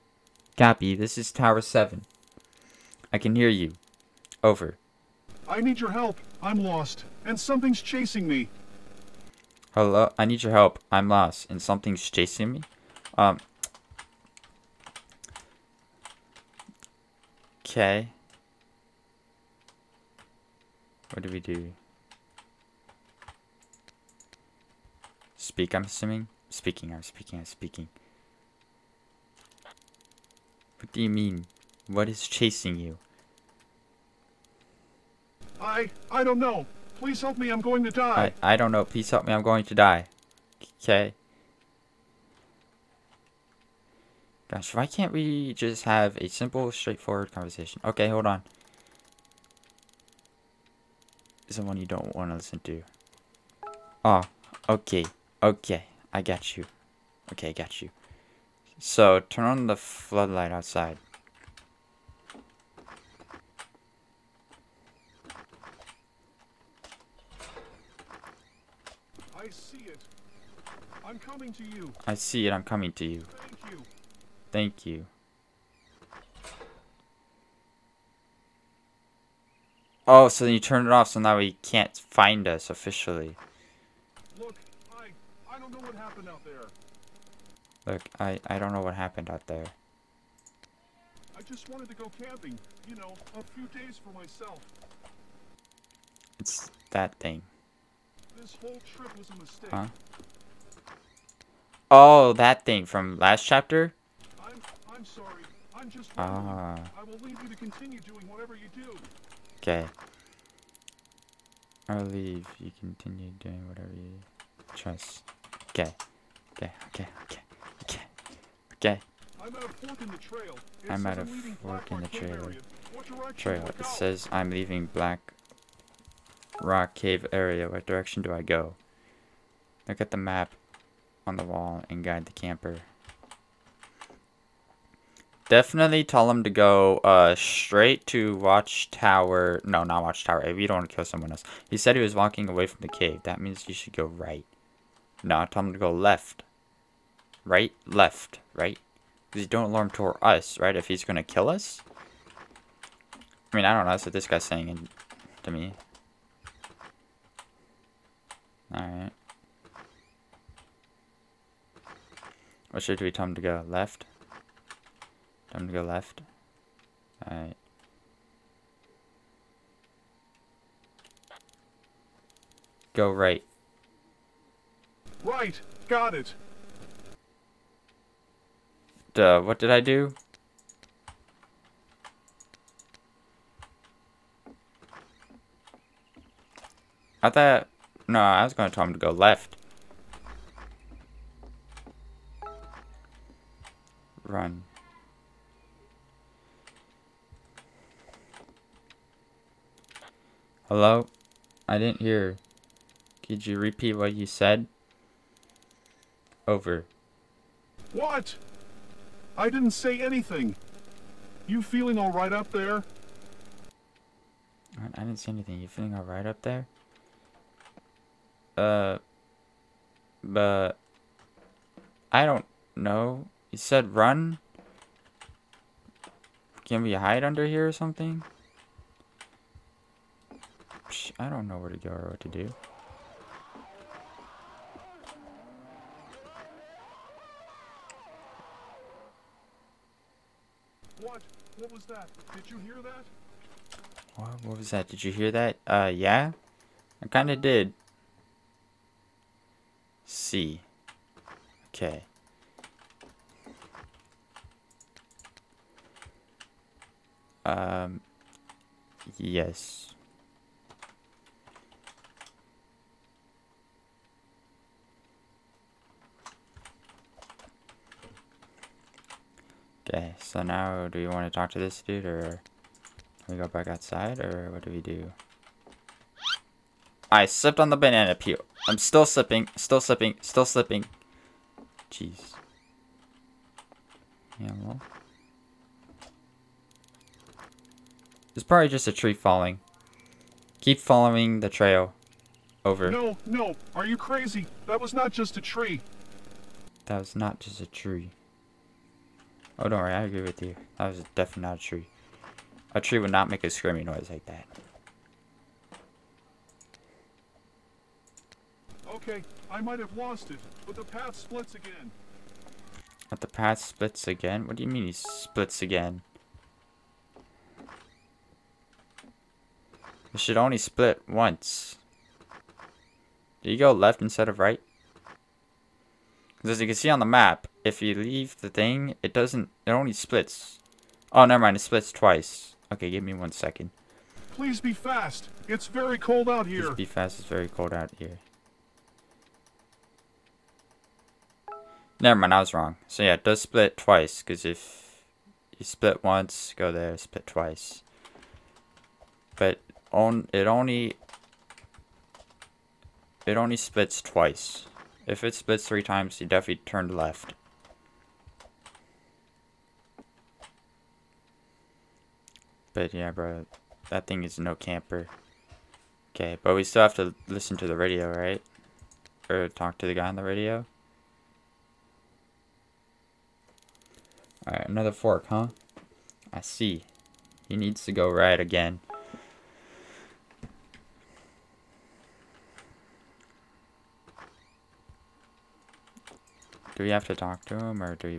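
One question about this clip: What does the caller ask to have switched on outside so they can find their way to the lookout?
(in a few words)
the floodlight.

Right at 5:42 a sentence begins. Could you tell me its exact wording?
So yeah, it does split twice, because if you split once, go there, split twice.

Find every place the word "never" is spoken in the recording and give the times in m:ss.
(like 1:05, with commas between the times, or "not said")
5:31, 5:42.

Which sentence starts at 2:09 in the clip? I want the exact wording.
Look at the map on the wall and guide the camper.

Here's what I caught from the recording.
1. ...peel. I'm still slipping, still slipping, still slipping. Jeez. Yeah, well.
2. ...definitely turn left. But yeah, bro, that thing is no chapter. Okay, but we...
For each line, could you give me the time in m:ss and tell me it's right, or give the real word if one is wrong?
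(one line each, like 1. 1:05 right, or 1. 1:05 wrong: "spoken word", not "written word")
1. 4:38 right
2. 5:56 wrong: "camper", not "chapter".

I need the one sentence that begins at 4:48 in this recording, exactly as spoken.
It's probably just a tree falling.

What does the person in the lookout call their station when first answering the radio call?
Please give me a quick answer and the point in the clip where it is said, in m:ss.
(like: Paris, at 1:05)
Tower 7, at 0:01.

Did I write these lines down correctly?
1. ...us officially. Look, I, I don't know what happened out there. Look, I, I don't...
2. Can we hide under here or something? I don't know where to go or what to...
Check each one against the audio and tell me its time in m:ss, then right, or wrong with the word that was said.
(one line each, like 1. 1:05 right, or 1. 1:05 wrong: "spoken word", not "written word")
1. 1:22 right
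2. 3:46 right.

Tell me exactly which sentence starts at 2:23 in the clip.
That means you should go right.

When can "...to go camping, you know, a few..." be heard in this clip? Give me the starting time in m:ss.
1:31.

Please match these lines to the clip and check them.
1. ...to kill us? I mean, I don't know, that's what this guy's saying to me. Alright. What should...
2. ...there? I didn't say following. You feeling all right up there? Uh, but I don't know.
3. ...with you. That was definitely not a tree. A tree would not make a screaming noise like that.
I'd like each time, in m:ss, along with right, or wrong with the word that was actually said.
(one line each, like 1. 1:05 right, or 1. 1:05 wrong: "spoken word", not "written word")
1. 2:31 right
2. 3:32 wrong: "anything", not "following"
3. 5:00 right.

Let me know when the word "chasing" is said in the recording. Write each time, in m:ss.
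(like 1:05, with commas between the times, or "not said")
0:07, 0:12, 0:32.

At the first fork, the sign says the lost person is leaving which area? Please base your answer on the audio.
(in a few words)
Black Rock Cave.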